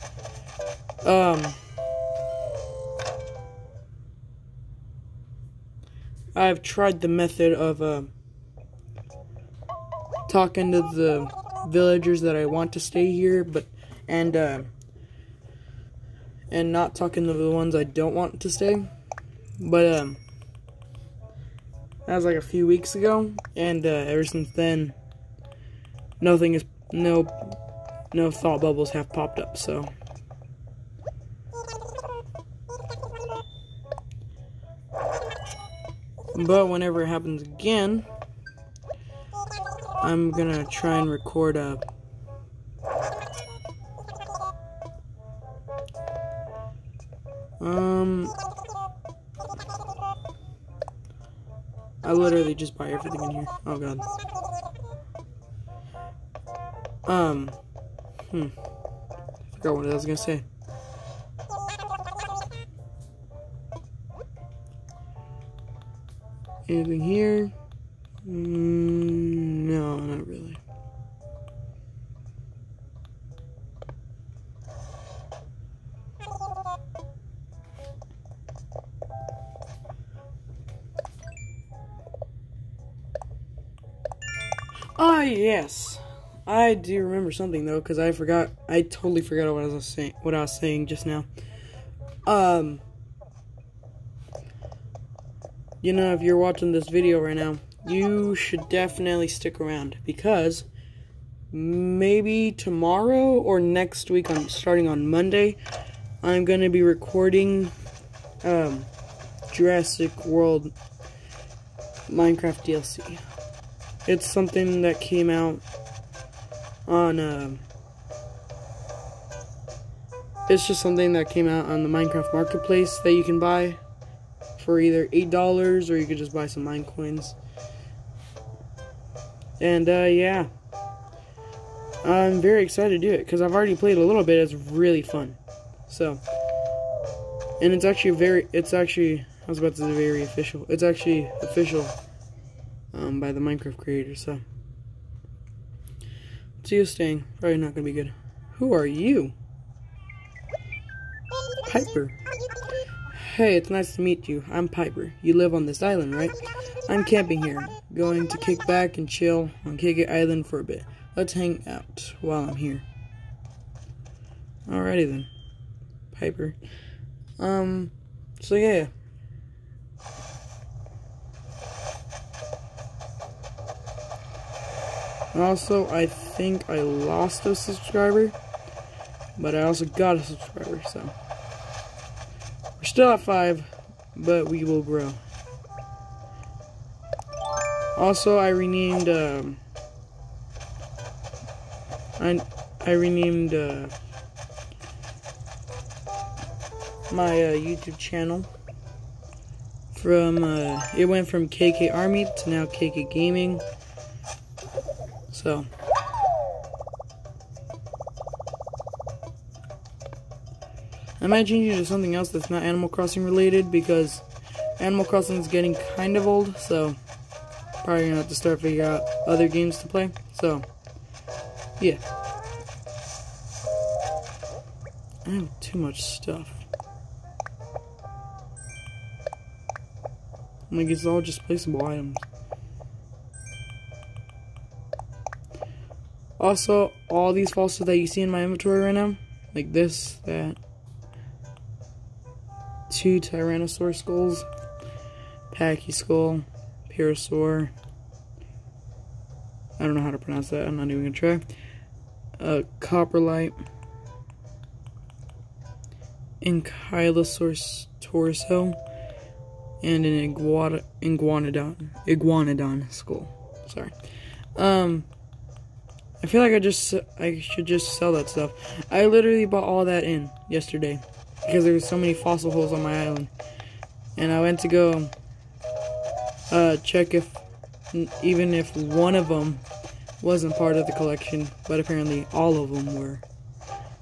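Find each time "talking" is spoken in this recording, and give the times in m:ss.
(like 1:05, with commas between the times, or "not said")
0:10, 0:16.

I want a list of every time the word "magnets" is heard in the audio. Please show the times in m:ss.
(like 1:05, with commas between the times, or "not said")
not said.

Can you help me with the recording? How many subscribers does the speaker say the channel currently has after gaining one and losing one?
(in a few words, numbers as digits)
5.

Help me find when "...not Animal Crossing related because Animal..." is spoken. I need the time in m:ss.
3:32.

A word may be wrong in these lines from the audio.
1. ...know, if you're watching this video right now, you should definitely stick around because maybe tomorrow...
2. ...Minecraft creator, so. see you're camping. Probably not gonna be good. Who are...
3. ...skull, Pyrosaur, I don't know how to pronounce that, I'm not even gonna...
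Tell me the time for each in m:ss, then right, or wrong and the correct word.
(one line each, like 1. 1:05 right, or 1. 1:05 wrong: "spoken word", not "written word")
1. 1:35 right
2. 2:23 wrong: "staying", not "camping"
3. 4:05 right.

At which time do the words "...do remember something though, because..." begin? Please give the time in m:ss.
1:26.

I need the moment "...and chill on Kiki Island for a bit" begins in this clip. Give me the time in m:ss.
2:38.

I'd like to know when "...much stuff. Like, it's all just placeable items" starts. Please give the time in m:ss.
3:45.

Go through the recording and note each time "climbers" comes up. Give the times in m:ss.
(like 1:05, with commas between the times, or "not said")
not said.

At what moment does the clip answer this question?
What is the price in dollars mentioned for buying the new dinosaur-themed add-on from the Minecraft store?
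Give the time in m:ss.
2:05.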